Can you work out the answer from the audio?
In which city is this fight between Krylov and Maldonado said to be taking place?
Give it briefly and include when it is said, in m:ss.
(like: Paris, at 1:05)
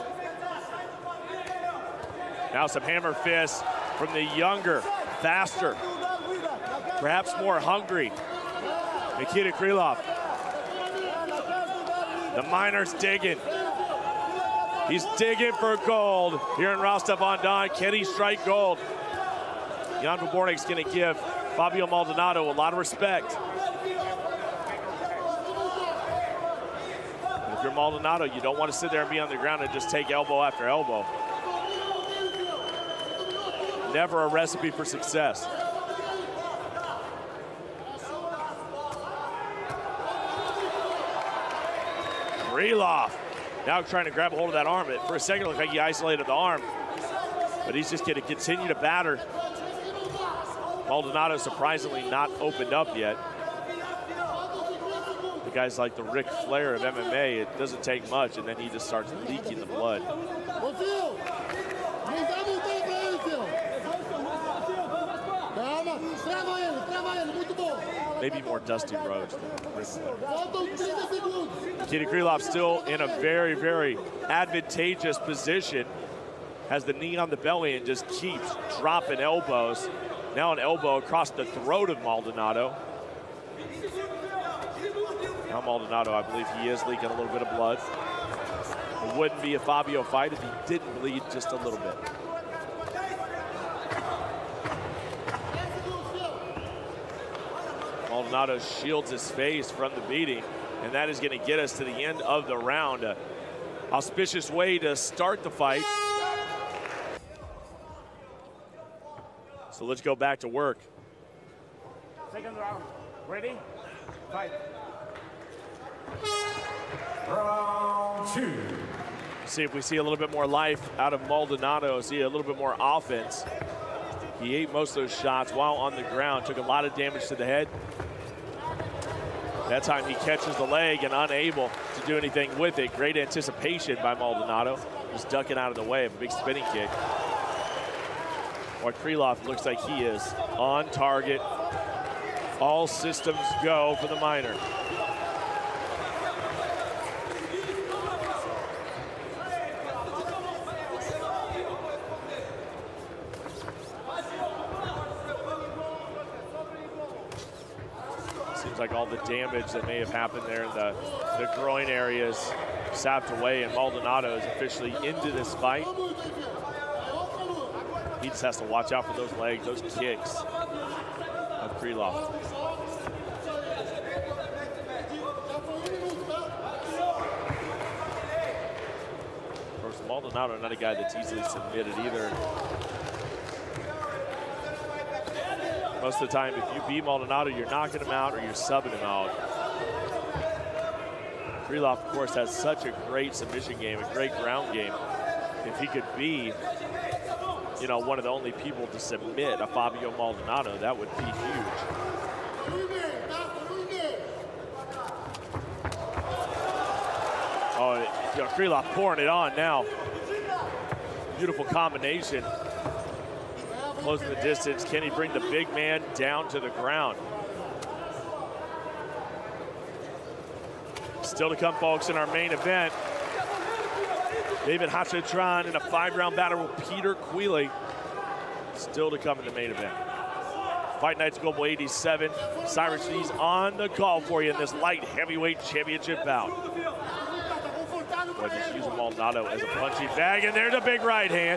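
Rostov-on-Don, at 0:16.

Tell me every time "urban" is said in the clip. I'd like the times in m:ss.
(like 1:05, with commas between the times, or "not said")
not said.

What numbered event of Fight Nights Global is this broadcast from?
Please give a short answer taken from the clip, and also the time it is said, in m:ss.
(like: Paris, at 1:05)
87, at 3:51.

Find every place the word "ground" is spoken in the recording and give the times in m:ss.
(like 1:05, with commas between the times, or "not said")
0:29, 2:06, 3:14, 3:36.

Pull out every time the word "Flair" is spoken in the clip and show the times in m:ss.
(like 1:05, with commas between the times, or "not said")
0:56, 1:09.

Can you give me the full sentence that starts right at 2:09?
That time he catches the leg and unable to do anything with it.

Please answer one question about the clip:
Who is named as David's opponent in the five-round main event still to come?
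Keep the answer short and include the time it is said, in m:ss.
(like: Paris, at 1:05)
Peter Queeley, at 3:46.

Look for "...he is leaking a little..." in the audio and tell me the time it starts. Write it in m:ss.
1:26.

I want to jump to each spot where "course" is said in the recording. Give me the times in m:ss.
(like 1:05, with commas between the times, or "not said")
2:59, 3:12.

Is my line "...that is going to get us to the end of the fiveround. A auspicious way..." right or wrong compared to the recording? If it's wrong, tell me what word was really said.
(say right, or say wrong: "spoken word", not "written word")
wrong: "round", not "fiveround".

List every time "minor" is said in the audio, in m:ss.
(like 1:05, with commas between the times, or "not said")
2:24.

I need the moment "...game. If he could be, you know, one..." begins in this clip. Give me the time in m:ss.
3:14.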